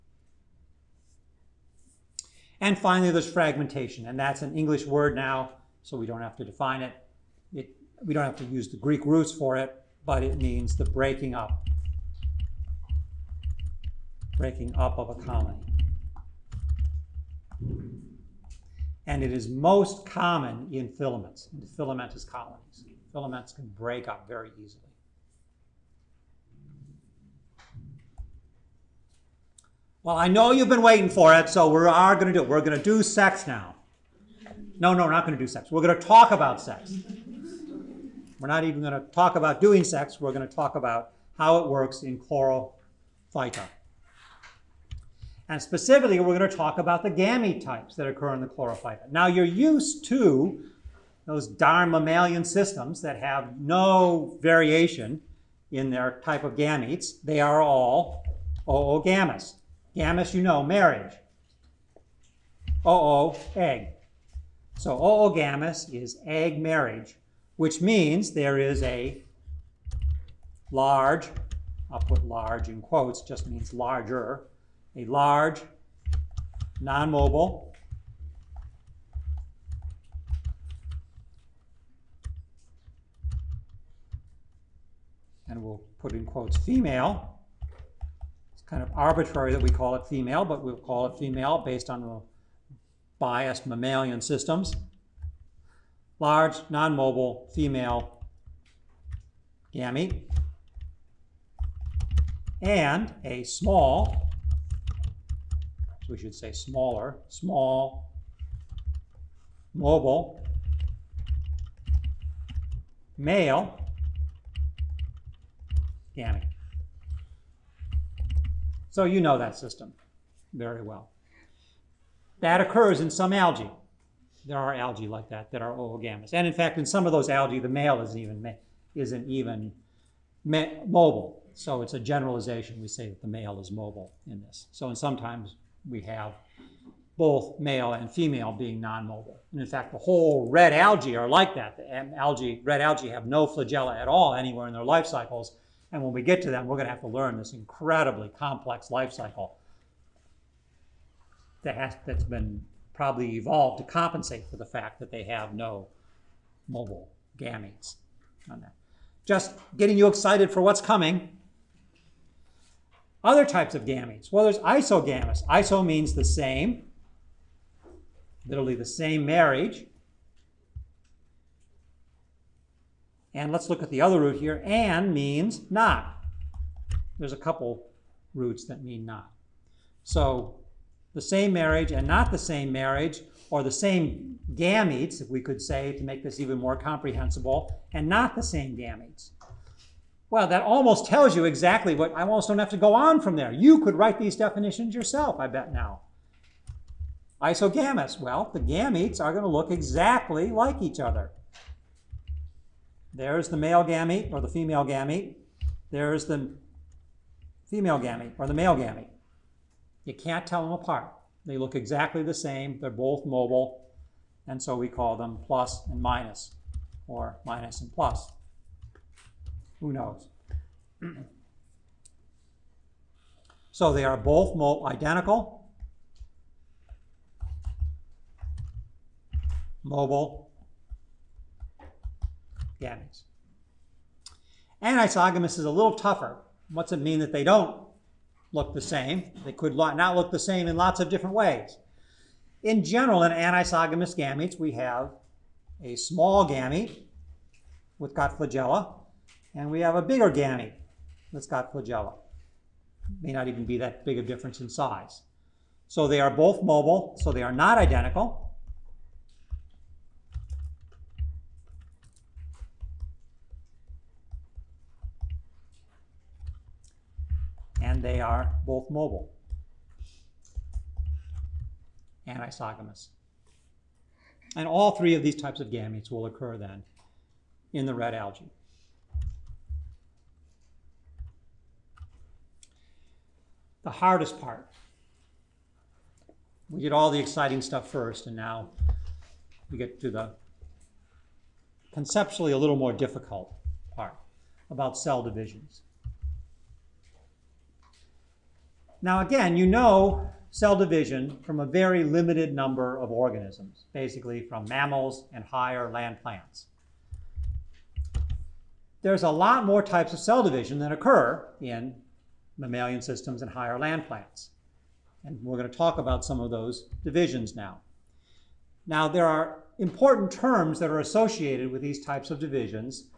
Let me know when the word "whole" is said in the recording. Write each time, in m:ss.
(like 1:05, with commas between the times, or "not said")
2:19.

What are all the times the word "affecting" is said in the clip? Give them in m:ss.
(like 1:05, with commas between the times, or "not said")
not said.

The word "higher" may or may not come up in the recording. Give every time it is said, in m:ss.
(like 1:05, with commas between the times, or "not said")
5:05, 5:13.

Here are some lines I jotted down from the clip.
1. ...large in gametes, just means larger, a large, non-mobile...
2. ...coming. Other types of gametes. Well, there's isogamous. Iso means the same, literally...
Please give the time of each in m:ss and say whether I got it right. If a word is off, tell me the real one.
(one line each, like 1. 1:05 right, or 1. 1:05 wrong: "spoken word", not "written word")
1. 1:12 wrong: "quotes", not "gametes"
2. 2:40 right.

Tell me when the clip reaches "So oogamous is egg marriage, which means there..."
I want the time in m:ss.
1:04.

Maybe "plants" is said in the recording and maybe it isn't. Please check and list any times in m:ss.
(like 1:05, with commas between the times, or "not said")
5:06, 5:14.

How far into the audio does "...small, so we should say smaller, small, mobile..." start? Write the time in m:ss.
1:43.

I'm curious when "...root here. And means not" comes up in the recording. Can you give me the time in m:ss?
2:54.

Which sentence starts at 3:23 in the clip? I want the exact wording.
There's the male gamete or the female gamete.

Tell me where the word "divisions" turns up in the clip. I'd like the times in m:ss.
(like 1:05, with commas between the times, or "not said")
4:55, 5:00, 5:10, 5:17, 5:22.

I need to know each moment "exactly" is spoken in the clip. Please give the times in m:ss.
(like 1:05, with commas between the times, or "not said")
3:11, 3:19, 3:31.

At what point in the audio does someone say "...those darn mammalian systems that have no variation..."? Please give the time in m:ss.
0:51.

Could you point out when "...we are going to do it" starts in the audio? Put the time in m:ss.
0:31.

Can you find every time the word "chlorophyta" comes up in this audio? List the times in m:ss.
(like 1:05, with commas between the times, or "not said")
0:42, 0:48.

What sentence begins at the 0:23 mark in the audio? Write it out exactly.
Filaments can break up very easily.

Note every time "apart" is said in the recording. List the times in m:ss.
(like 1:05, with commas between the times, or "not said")
3:30.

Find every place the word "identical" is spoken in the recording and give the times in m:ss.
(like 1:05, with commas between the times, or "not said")
3:44, 4:17.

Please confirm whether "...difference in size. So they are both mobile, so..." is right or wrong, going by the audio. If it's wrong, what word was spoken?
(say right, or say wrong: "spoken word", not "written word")
right.